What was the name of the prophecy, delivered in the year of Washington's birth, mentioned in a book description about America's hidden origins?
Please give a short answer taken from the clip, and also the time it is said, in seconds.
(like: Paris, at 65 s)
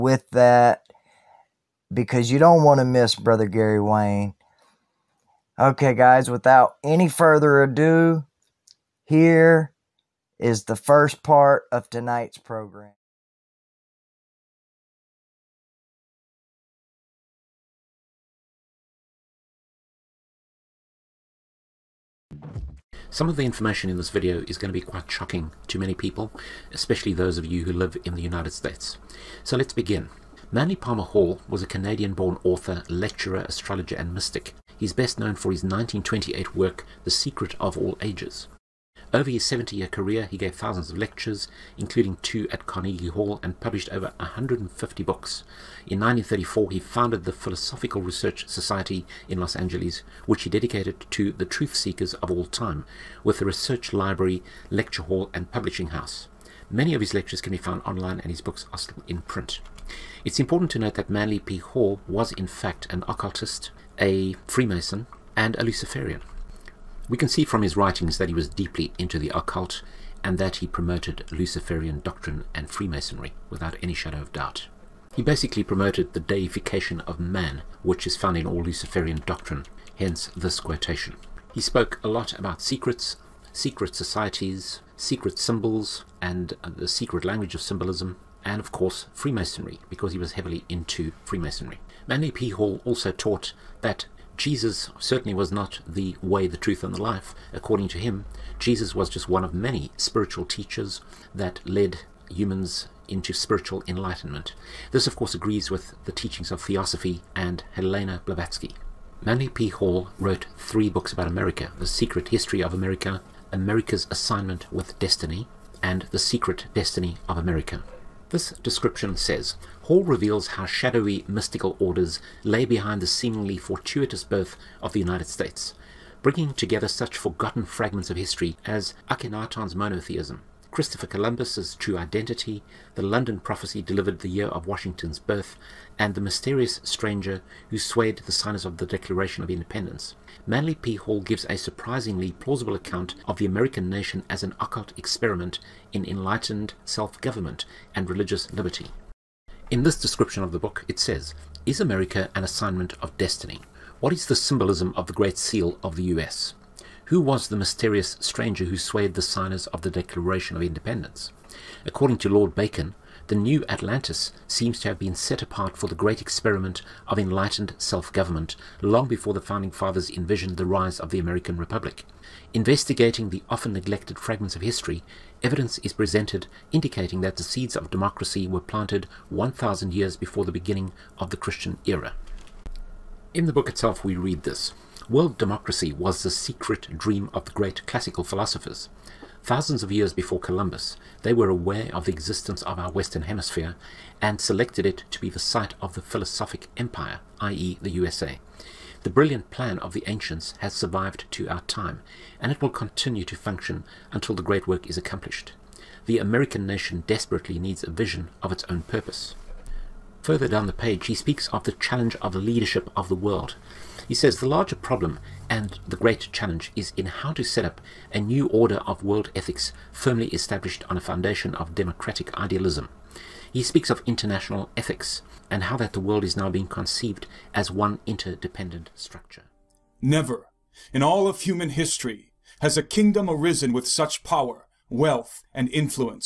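London prophecy, at 133 s.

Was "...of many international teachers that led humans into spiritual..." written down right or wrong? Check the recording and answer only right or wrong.
wrong.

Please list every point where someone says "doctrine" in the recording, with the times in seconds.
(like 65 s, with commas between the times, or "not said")
72 s, 79 s.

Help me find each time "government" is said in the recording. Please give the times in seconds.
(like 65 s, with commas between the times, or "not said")
146 s, 167 s.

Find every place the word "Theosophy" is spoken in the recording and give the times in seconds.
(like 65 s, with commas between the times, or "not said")
106 s.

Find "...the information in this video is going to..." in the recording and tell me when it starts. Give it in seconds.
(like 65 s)
23 s.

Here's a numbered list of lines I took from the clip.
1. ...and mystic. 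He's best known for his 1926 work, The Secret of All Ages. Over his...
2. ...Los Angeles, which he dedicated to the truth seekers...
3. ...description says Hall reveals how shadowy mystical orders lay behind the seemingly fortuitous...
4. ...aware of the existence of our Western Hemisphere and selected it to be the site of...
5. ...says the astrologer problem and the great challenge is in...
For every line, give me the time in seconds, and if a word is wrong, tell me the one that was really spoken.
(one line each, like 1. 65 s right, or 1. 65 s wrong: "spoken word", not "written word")
1. 33 s wrong: "1928", not "1926"
2. 49 s right
3. 118 s right
4. 191 s right
5. 214 s wrong: "larger", not "astrologer".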